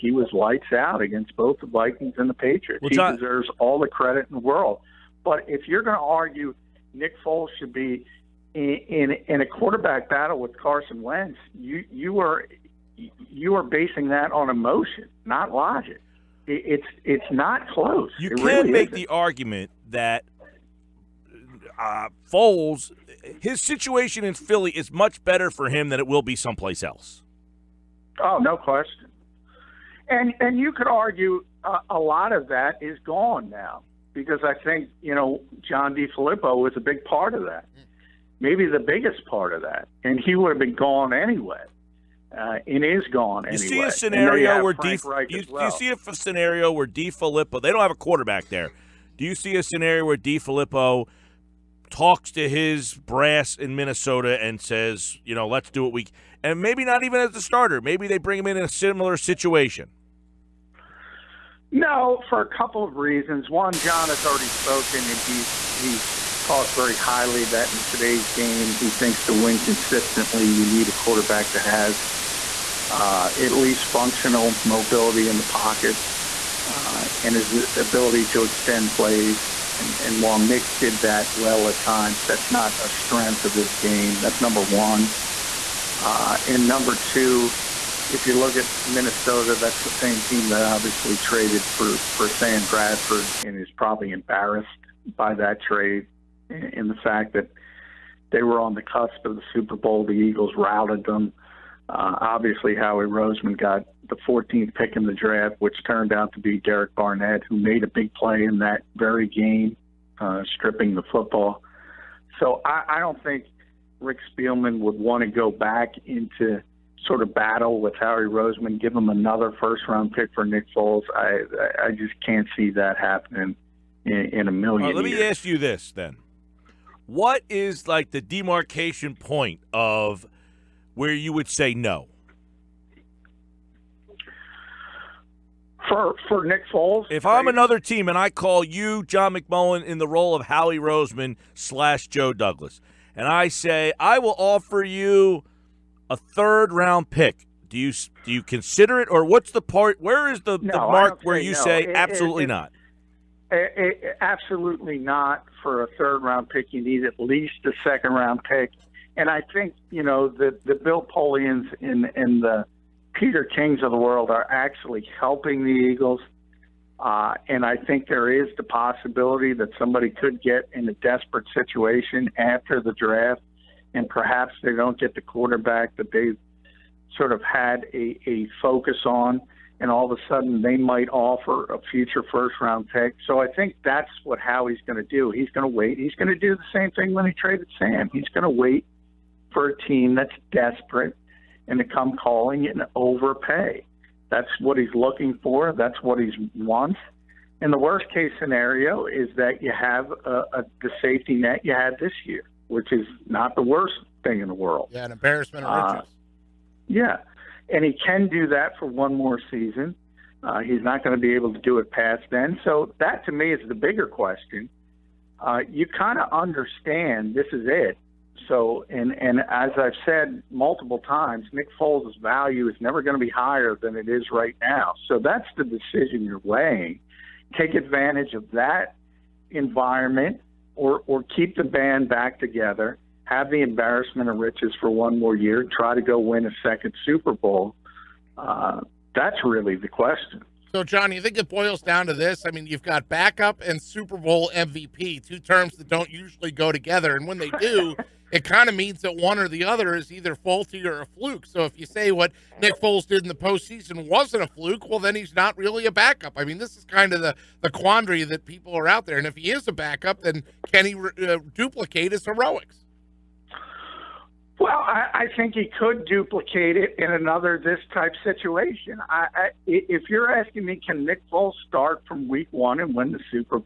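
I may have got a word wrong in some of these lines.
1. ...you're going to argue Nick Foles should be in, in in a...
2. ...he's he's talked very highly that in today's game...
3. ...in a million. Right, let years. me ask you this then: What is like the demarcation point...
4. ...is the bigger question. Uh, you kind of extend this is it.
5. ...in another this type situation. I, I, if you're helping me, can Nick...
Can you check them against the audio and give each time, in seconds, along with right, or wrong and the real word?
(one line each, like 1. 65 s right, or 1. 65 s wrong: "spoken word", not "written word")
1. 5 s right
2. 65 s right
3. 124 s right
4. 213 s wrong: "understand", not "extend"
5. 266 s wrong: "asking", not "helping".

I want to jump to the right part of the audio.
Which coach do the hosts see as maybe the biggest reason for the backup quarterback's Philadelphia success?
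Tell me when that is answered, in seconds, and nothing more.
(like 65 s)
35 s.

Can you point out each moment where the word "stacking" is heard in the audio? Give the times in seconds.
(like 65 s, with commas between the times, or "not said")
not said.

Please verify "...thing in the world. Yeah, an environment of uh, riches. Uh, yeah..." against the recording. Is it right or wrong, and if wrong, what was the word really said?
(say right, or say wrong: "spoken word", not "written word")
wrong: "embarrassment", not "environment".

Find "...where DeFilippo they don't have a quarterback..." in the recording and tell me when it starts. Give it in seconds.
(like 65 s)
46 s.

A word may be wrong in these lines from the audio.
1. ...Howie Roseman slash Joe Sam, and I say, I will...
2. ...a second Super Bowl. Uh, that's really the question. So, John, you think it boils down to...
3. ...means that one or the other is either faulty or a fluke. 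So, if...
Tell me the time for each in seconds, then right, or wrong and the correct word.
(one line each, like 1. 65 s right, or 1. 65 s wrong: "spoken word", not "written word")
1. 140 s wrong: "Douglas", not "Sam"
2. 236 s right
3. 248 s right.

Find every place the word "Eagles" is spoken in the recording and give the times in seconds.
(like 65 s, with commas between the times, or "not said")
100 s, 165 s.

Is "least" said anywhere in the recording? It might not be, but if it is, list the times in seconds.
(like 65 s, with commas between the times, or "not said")
73 s, 157 s.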